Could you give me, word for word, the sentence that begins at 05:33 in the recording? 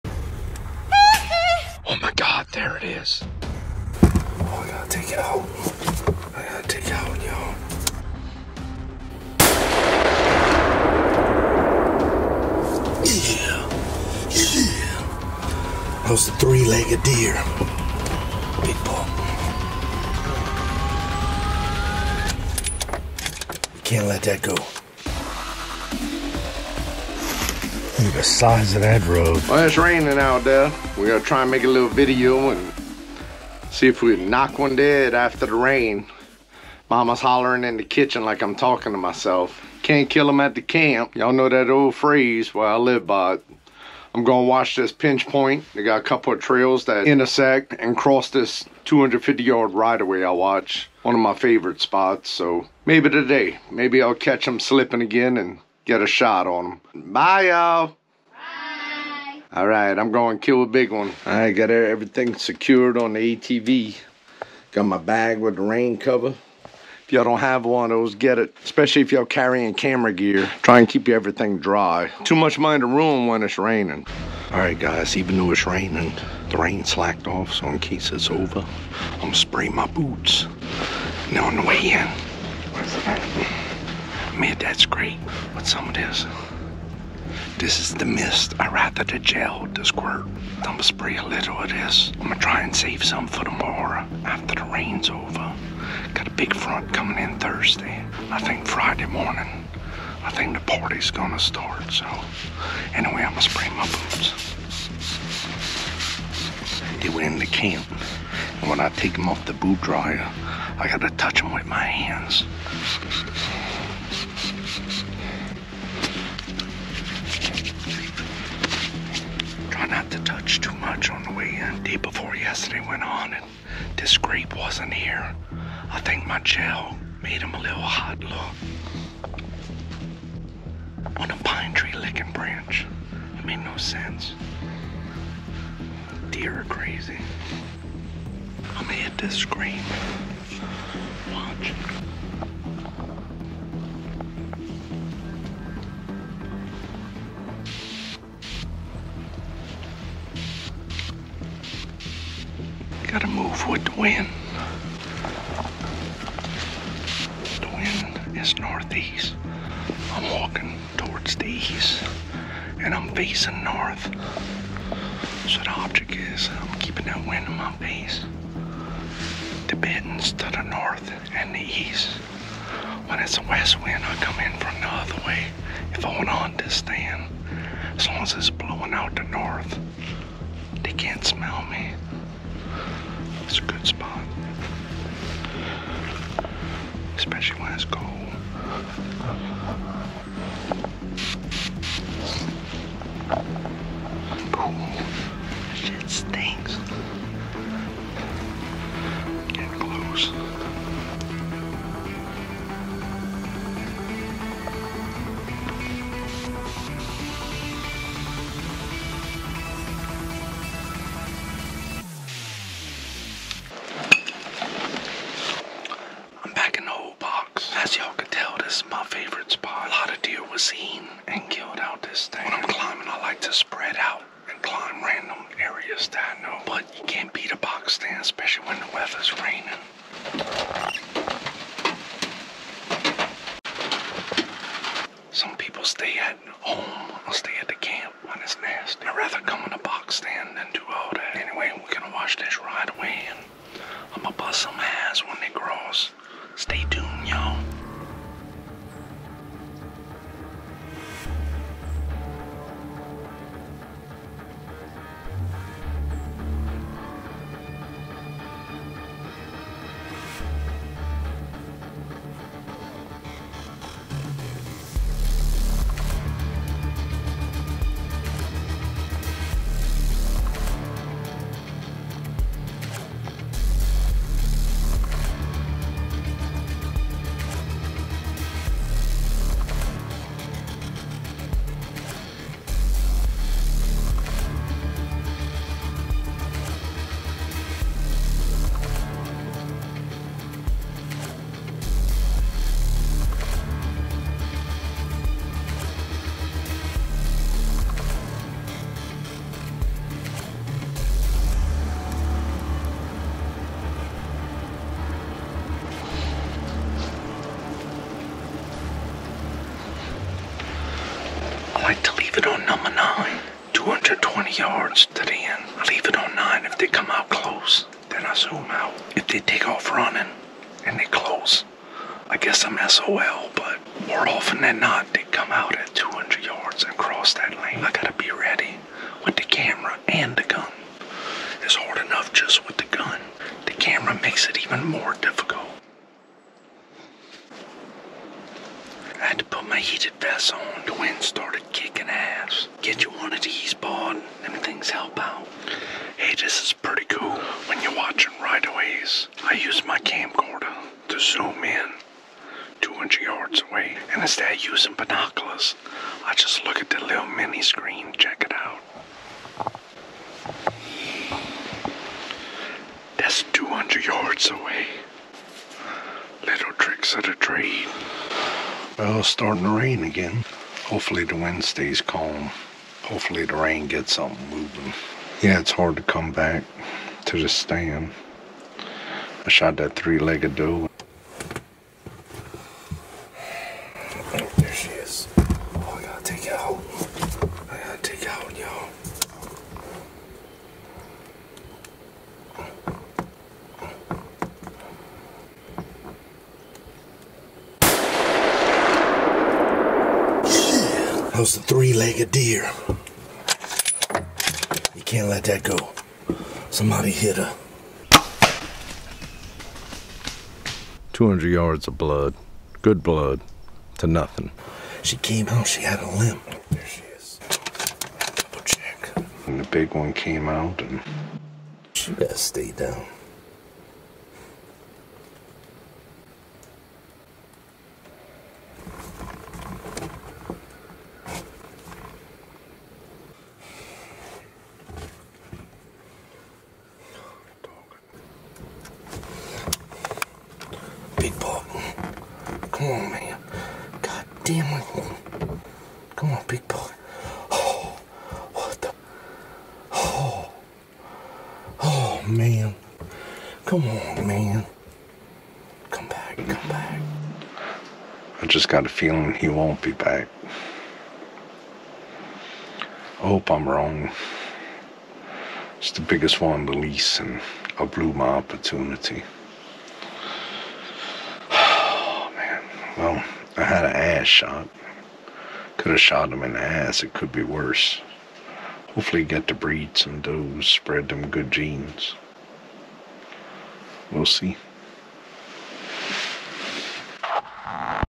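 The camera makes it even more difficult.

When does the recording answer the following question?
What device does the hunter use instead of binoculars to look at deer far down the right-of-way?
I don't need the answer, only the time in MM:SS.
05:49.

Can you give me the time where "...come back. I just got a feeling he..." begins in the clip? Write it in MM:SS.
07:36.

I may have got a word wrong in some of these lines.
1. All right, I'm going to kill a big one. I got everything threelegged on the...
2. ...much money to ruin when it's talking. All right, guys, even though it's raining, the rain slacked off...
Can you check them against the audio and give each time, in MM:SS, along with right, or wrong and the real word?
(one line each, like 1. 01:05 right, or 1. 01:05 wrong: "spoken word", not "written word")
1. 00:59 wrong: "secured", not "threelegged"
2. 01:12 wrong: "raining", not "talking".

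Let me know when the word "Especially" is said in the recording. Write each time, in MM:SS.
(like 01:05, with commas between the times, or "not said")
01:08, 03:07.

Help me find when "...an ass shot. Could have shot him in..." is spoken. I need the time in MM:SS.
07:53.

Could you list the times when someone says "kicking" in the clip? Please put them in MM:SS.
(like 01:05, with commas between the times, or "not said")
05:41.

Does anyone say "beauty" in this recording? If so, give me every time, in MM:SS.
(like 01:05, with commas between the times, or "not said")
not said.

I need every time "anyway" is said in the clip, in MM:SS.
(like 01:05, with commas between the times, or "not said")
01:42, 04:01.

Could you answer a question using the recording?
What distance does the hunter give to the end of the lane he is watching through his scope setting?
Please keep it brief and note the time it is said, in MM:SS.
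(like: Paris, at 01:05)
220 yards, at 05:13.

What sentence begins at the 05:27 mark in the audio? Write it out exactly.
I gotta be ready with the camera and the gun.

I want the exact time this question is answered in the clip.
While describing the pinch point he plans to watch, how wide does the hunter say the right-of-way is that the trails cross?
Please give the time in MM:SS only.
00:48.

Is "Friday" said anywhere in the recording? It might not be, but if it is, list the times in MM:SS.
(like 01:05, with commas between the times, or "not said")
01:38.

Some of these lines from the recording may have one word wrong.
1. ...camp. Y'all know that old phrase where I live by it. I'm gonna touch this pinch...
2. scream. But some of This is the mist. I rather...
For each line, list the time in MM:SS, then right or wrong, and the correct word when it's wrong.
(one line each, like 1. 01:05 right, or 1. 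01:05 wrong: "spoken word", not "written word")
1. 00:40 wrong: "watch", not "touch"
2. 01:25 right.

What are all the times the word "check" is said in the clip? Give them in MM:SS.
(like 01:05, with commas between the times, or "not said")
05:58, 06:58.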